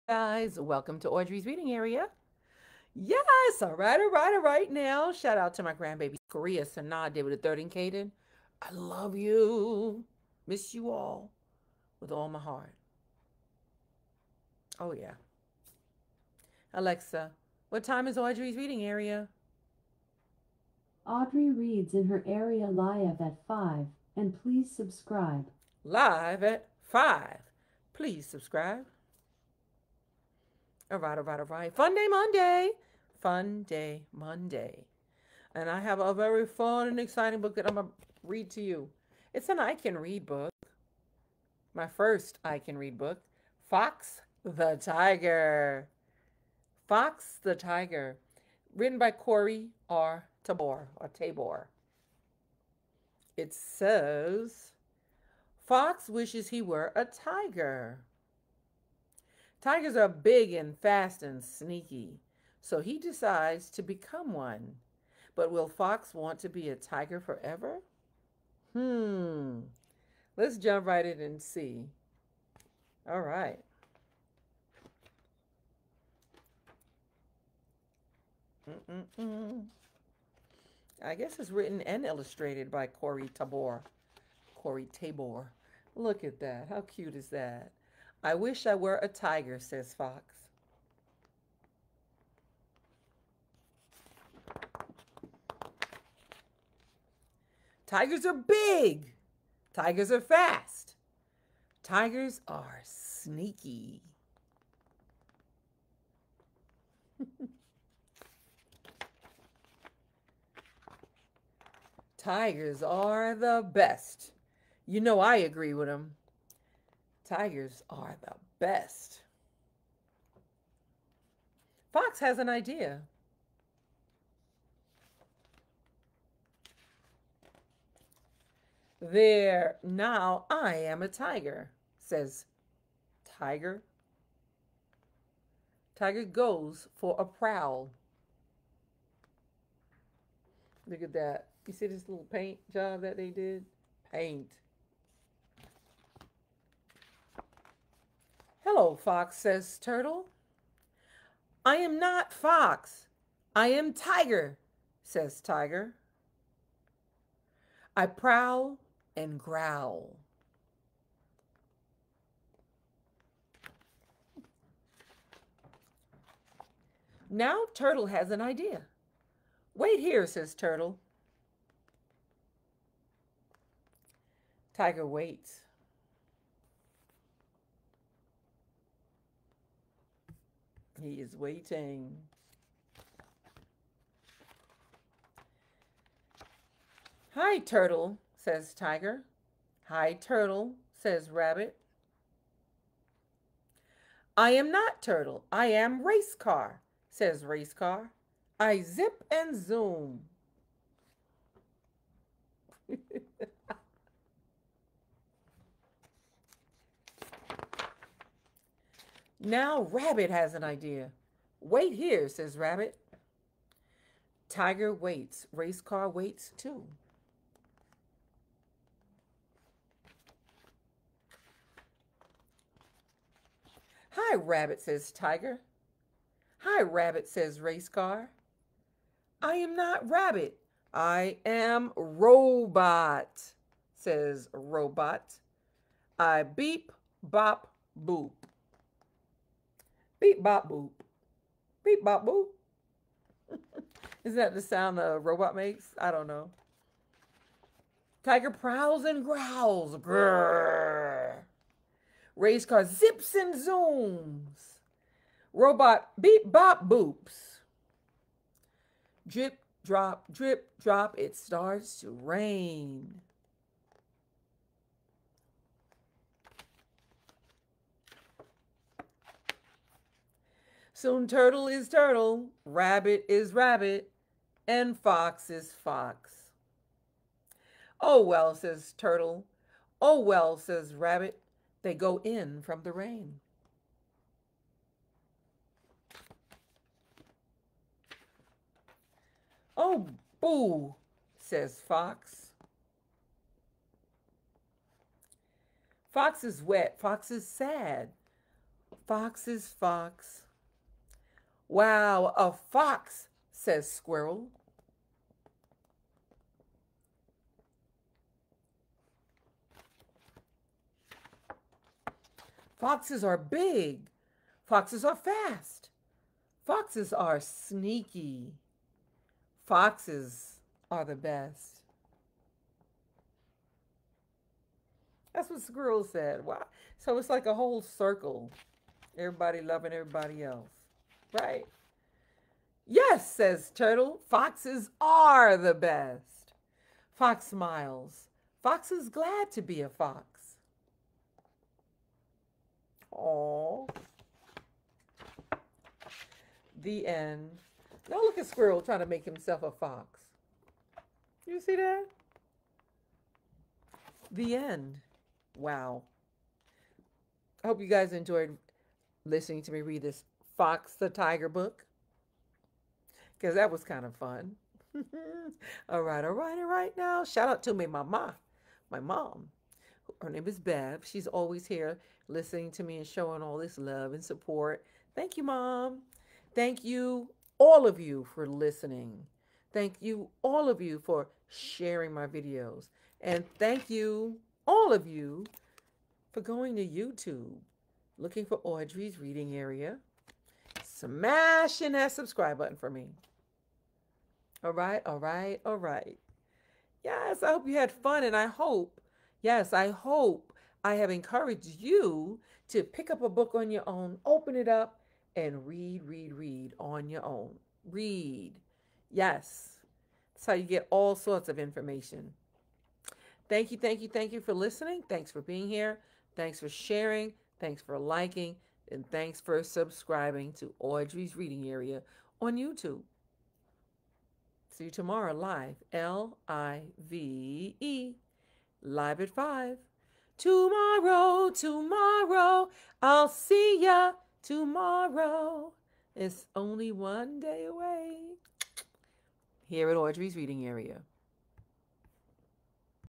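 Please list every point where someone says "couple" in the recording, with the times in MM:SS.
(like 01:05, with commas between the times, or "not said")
not said.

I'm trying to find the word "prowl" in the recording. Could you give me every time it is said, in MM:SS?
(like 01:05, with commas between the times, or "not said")
02:17, 02:38, 04:08.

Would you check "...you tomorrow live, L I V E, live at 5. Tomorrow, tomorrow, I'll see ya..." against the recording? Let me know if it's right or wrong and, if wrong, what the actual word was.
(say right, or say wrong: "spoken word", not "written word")
right.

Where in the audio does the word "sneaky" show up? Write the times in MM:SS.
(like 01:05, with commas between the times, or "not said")
01:01, 01:42, 05:17.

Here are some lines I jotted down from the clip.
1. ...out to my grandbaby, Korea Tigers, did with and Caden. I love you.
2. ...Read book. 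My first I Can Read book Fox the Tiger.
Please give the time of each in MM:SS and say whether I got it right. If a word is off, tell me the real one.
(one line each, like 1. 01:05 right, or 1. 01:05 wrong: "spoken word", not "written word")
1. 00:05 wrong: "Sanaa", not "Tigers"
2. 00:39 right.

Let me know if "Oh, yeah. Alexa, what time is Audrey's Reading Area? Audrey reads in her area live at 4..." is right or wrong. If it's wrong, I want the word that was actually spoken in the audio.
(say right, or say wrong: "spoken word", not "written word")
wrong: "5", not "4".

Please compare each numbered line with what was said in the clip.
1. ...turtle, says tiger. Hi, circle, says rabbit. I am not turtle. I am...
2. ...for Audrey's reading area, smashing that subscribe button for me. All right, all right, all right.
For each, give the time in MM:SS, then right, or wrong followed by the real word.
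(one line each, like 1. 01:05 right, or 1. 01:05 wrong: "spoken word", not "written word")
1. 03:07 wrong: "turtle", not "circle"
2. 06:28 right.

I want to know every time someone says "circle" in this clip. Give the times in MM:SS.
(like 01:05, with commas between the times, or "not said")
05:27.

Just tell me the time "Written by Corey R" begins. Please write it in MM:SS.
00:48.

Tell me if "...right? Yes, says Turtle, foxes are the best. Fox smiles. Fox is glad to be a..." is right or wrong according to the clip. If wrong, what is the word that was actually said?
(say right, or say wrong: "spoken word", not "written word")
right.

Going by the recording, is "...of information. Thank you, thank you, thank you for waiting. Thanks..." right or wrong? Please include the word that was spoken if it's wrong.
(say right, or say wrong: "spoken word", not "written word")
wrong: "listening", not "waiting".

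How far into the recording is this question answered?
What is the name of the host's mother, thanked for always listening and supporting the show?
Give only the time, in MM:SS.
06:10.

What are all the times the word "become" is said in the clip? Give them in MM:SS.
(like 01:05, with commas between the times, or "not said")
01:03.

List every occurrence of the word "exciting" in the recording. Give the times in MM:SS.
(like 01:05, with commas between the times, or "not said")
00:36.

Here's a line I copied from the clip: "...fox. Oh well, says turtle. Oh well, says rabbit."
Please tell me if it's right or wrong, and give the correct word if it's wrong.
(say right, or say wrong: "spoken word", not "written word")
right.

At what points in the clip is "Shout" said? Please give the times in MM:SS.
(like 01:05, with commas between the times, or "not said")
00:05, 06:07.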